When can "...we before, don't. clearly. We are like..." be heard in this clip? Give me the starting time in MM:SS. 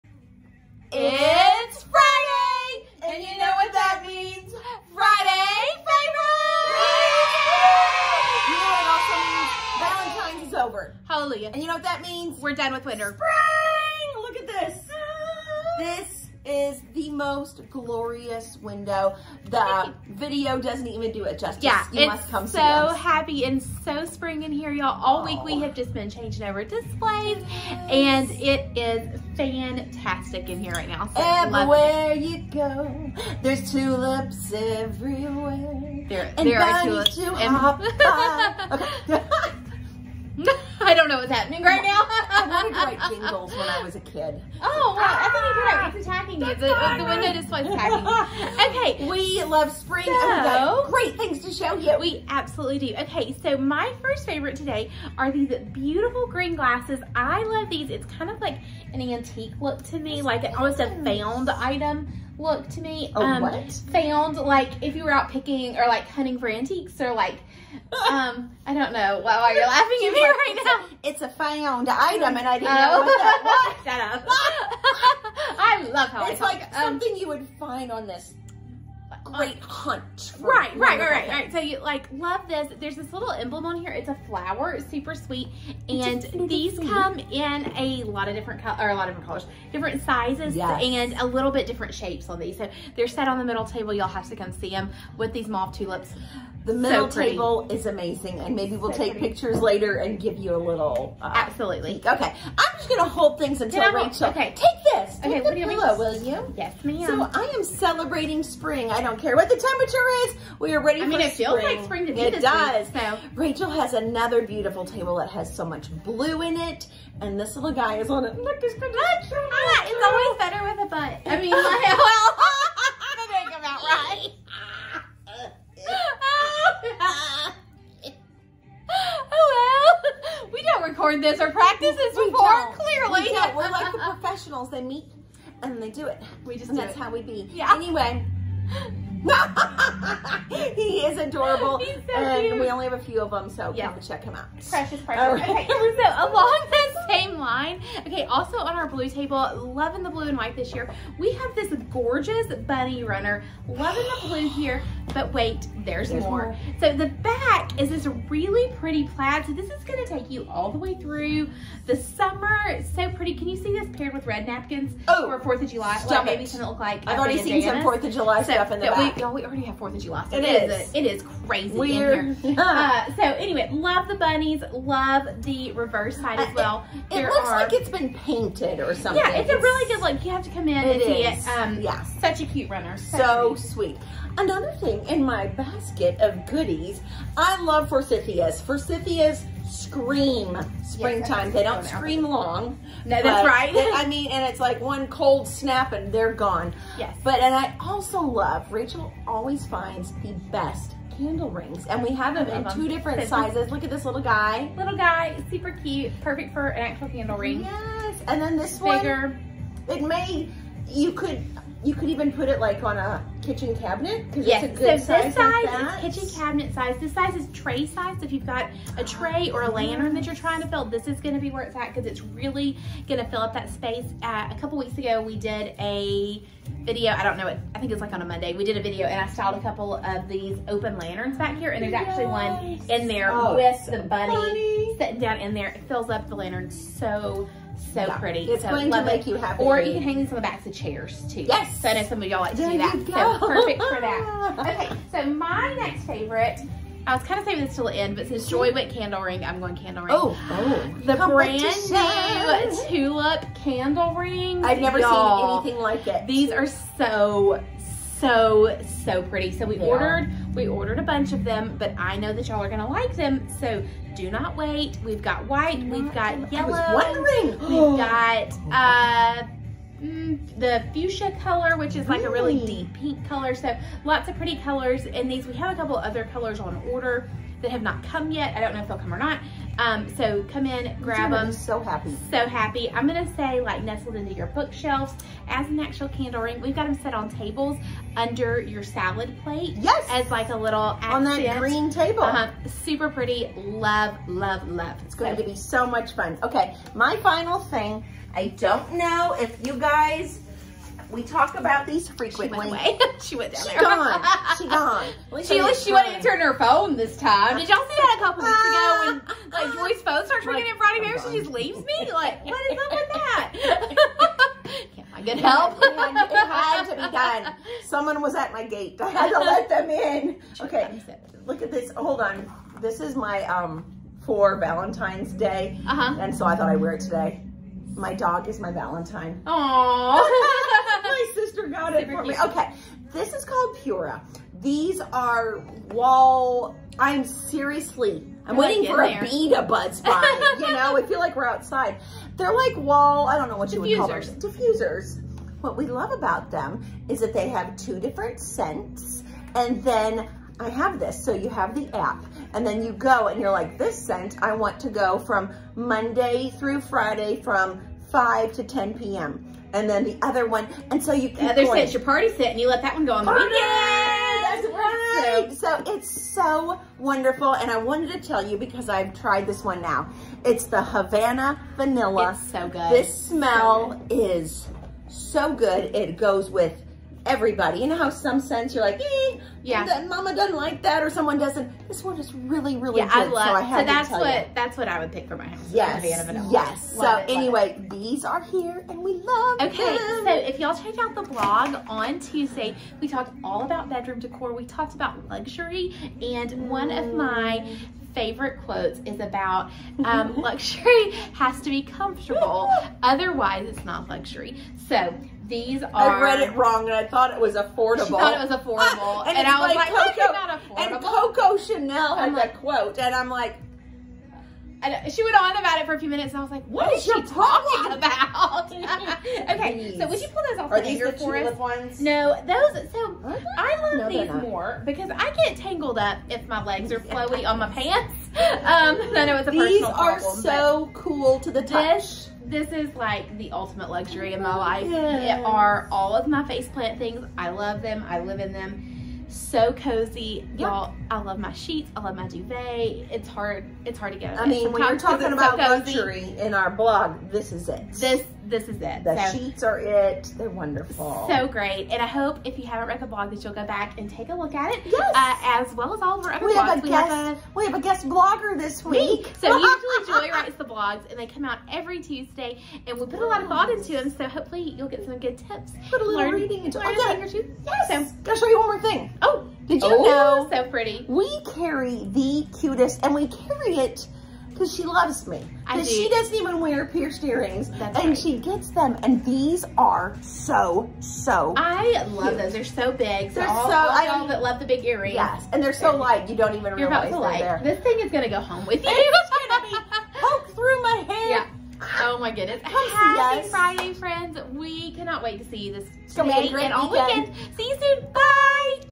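02:12.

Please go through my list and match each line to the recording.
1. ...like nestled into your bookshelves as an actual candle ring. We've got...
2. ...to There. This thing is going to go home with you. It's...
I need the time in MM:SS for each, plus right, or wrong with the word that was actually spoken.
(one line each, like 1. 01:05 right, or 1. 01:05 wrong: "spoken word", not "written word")
1. 04:43 right
2. 08:07 right.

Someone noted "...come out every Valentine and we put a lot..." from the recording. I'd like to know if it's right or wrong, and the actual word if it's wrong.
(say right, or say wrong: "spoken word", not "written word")
wrong: "Tuesday", not "Valentine".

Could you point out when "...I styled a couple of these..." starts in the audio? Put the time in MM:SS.
03:49.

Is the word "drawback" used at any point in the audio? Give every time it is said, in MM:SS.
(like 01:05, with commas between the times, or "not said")
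not said.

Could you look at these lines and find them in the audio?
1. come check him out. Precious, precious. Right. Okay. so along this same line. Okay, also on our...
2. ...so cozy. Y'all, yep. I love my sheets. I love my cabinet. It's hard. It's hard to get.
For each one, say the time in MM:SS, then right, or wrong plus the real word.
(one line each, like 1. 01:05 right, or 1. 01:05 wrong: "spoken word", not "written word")
1. 02:23 right
2. 07:19 wrong: "duvet", not "cabinet".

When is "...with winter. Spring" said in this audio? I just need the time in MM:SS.
00:12.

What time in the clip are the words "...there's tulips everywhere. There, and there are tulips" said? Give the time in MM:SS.
00:33.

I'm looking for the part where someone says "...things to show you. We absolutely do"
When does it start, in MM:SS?
00:51.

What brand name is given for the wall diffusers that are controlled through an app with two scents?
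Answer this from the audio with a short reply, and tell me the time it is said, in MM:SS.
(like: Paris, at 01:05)
Pura, at 05:33.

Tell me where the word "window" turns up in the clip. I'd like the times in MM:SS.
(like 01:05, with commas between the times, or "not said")
00:18, 00:47.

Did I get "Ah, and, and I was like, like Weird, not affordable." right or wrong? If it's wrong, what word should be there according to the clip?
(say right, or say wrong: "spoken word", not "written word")
wrong: "Coco", not "Weird".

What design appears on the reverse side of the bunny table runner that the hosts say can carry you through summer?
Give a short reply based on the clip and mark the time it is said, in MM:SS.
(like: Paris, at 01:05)
Plaid, at 02:39.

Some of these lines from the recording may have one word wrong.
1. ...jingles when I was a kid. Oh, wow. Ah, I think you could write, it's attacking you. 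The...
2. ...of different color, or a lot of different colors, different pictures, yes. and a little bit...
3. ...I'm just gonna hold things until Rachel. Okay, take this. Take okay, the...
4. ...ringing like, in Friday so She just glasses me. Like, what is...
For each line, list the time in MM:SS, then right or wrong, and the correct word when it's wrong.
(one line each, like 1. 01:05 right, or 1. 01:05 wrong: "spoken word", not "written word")
1. 00:43 right
2. 01:28 wrong: "sizes", not "pictures"
3. 01:42 right
4. 05:10 wrong: "leaves", not "glasses".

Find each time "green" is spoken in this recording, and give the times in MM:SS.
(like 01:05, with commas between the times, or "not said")
00:56, 04:51.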